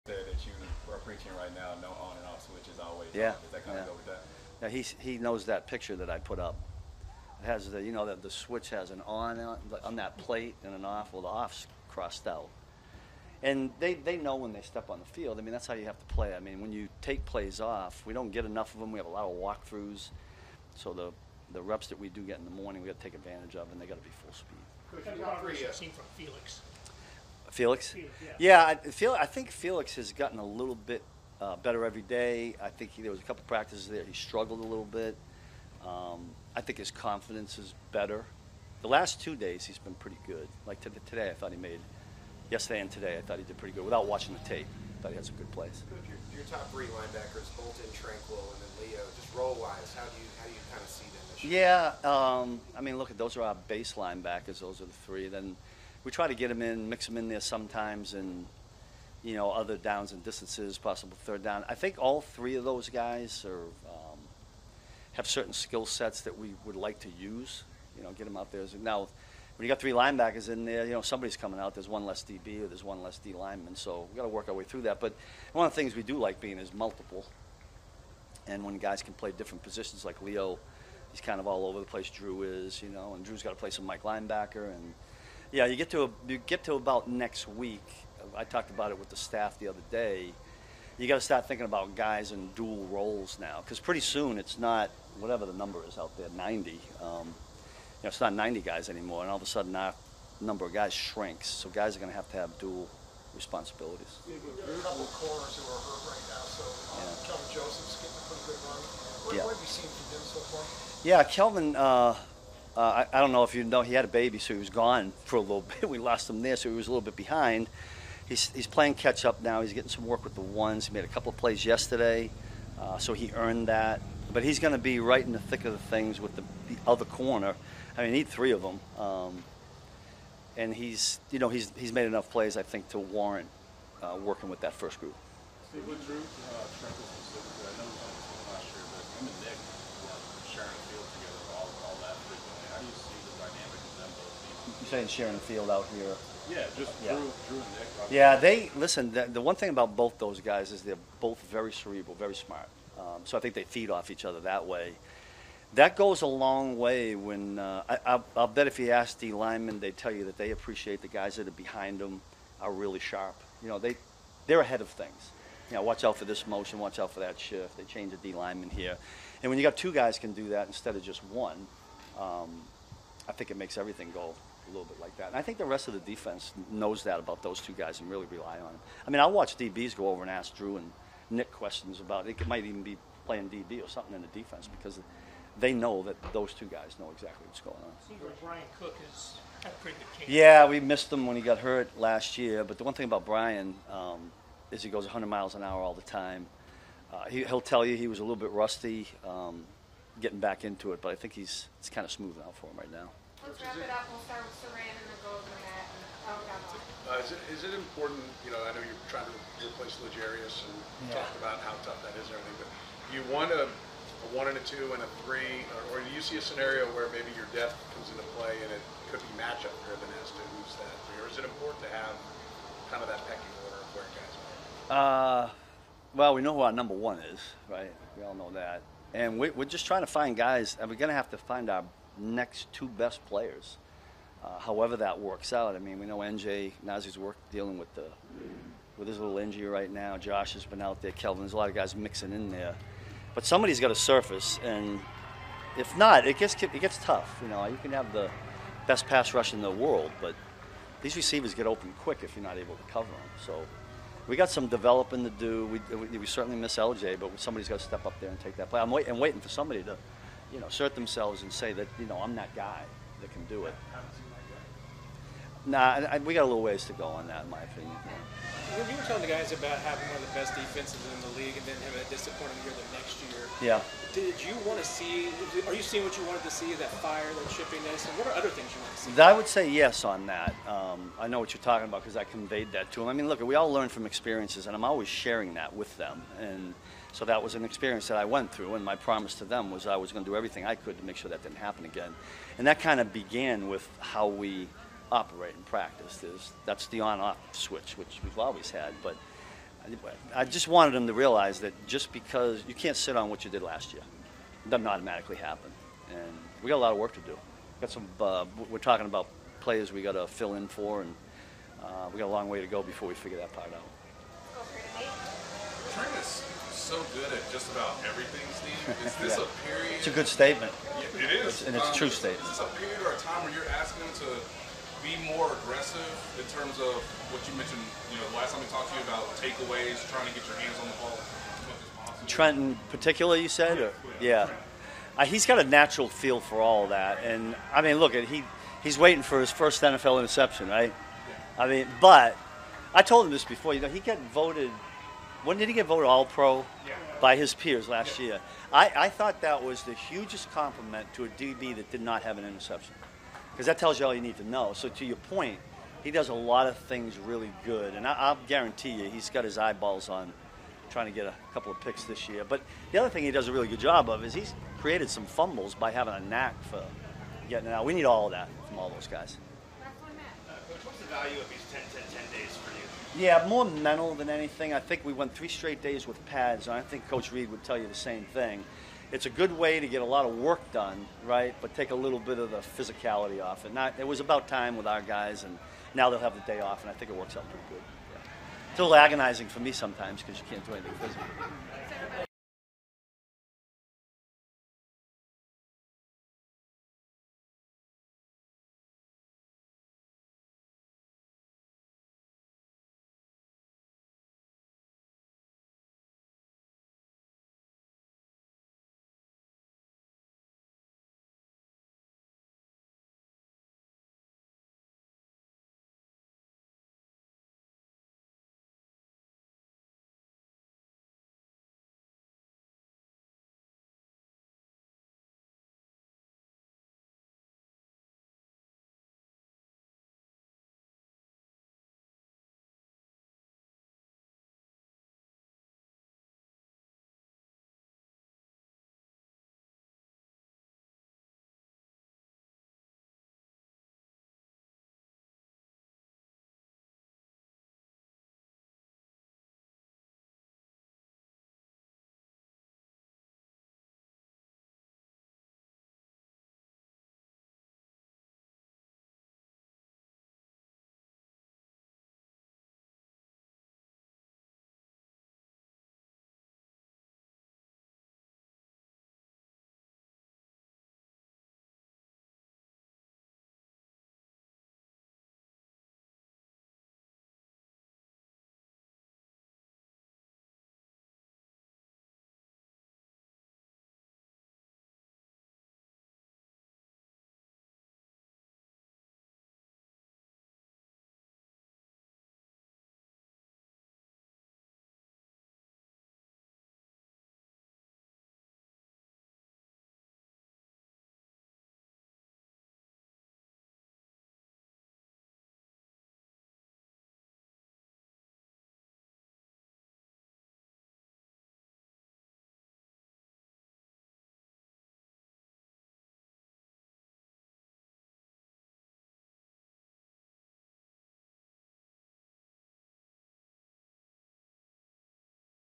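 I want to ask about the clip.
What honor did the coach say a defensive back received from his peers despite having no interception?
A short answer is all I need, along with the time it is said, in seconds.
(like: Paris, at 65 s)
All Pro, at 346 s.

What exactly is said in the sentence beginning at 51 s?
Yeah, um, I mean, look, at those are our base linebackers.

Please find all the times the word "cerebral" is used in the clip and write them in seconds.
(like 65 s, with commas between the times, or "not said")
151 s.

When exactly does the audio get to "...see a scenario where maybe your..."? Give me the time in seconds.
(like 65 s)
216 s.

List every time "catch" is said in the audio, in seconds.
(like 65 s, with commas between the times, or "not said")
118 s.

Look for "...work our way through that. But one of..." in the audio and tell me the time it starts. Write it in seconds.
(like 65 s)
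74 s.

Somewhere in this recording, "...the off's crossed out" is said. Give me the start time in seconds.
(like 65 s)
11 s.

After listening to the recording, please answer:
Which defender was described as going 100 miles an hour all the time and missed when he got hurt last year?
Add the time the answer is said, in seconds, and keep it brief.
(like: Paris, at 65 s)
Bryan Cook, at 188 s.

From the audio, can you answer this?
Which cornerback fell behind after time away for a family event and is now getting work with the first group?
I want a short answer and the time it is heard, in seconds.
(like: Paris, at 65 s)
Kelvin Joseph, at 107 s.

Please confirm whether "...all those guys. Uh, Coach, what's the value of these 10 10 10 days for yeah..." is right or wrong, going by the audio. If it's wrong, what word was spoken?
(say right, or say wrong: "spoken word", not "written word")
right.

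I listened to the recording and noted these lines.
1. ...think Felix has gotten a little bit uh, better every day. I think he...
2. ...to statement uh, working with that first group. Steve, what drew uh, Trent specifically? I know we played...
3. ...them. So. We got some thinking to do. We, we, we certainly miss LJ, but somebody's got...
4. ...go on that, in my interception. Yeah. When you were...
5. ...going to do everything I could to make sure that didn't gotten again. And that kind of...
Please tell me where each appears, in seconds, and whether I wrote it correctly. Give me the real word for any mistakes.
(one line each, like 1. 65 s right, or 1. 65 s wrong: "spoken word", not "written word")
1. 29 s right
2. 132 s wrong: "warrant", not "statement"
3. 253 s wrong: "developing", not "thinking"
4. 266 s wrong: "opinion", not "interception"
5. 290 s wrong: "happen", not "gotten".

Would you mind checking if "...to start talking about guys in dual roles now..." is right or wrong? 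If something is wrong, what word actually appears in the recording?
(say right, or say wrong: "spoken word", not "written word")
wrong: "thinking", not "talking".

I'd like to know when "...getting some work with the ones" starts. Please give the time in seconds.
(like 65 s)
119 s.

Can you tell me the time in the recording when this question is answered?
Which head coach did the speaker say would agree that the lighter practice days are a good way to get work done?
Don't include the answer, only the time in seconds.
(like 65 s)
377 s.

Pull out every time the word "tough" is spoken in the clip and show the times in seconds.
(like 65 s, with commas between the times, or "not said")
211 s, 246 s.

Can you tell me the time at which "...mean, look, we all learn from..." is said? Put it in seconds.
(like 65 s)
283 s.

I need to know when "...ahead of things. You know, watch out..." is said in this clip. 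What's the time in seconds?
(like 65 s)
164 s.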